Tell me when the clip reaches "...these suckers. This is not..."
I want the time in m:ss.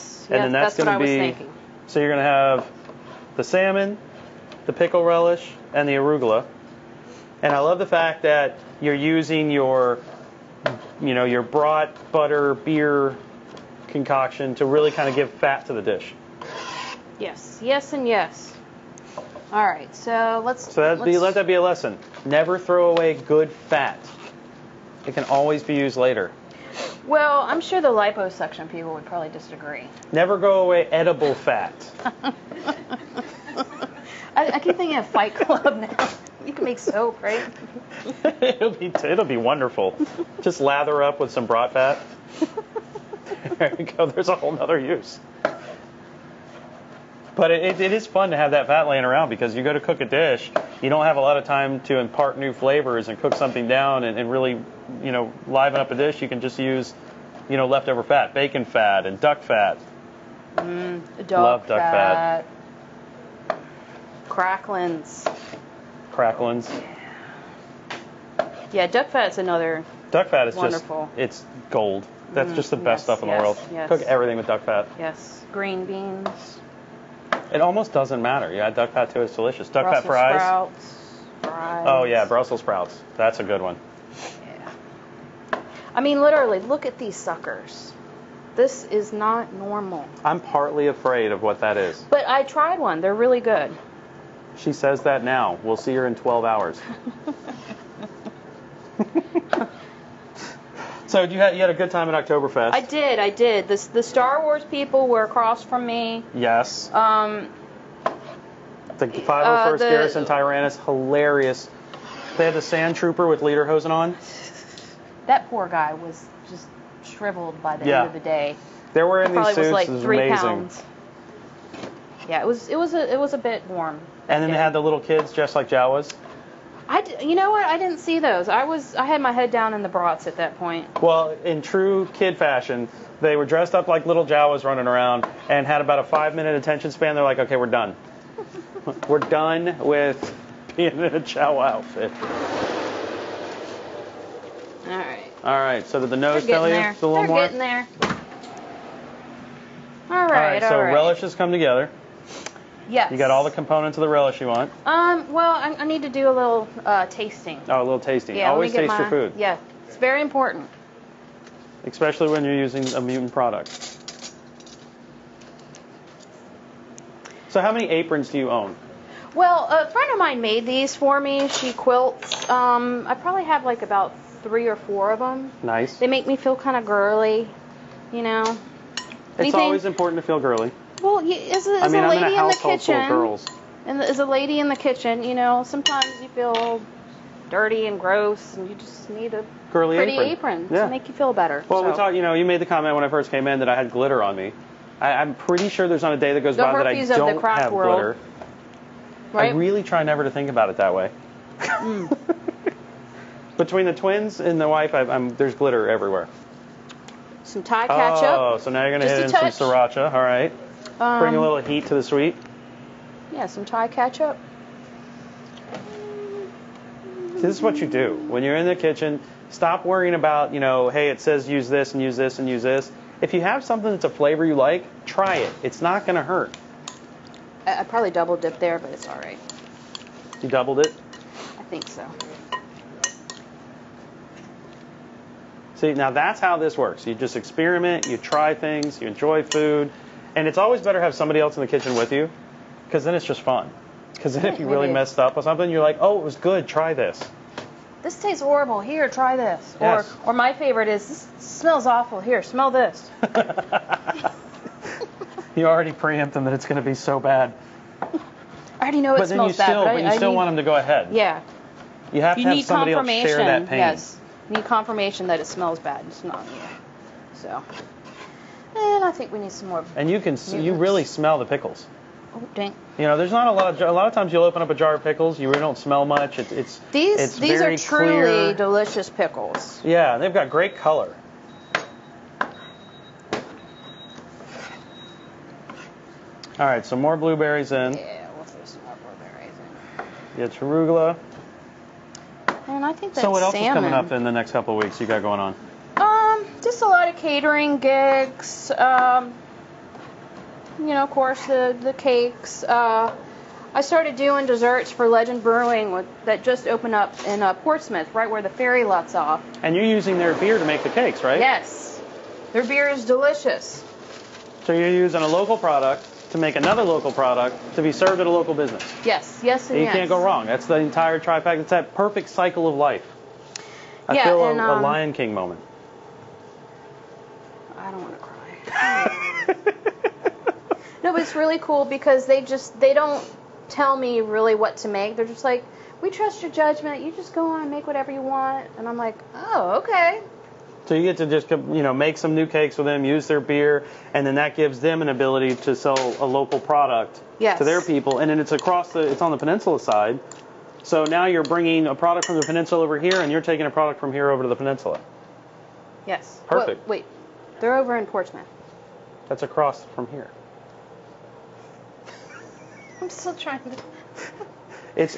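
1:26.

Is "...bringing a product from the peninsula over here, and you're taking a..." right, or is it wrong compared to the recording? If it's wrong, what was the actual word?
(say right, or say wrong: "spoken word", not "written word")
right.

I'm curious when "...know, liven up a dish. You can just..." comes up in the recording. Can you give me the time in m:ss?
0:55.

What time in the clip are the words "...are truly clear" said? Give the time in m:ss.
4:37.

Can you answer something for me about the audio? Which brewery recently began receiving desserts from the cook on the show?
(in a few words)
Legend Brewing.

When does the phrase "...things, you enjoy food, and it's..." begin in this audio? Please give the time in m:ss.
3:58.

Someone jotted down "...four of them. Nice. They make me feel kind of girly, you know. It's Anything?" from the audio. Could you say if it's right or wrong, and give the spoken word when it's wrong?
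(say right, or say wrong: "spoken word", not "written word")
right.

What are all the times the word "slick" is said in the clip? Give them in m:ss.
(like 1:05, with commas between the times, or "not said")
not said.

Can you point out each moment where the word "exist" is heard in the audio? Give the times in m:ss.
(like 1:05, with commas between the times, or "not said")
not said.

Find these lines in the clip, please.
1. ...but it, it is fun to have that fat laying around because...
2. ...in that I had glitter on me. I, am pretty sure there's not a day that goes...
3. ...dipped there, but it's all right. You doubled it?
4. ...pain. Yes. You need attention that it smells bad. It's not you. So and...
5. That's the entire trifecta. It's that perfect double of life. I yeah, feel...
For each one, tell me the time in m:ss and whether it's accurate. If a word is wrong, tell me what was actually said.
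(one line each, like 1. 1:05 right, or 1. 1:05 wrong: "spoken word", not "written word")
1. 0:47 right
2. 3:13 right
3. 3:48 right
4. 4:23 wrong: "confirmation", not "attention"
5. 5:20 wrong: "cycle", not "double".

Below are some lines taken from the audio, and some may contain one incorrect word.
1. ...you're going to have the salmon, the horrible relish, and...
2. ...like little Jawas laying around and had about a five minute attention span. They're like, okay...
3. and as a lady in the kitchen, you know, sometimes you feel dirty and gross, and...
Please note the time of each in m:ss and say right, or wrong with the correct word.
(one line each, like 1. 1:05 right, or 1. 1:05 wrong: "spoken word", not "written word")
1. 0:02 wrong: "pickle", not "horrible"
2. 2:13 wrong: "running", not "laying"
3. 3:03 right.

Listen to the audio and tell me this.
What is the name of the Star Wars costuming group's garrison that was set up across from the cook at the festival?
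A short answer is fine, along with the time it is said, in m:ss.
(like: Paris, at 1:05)
Garrison Tyrannus, at 1:49.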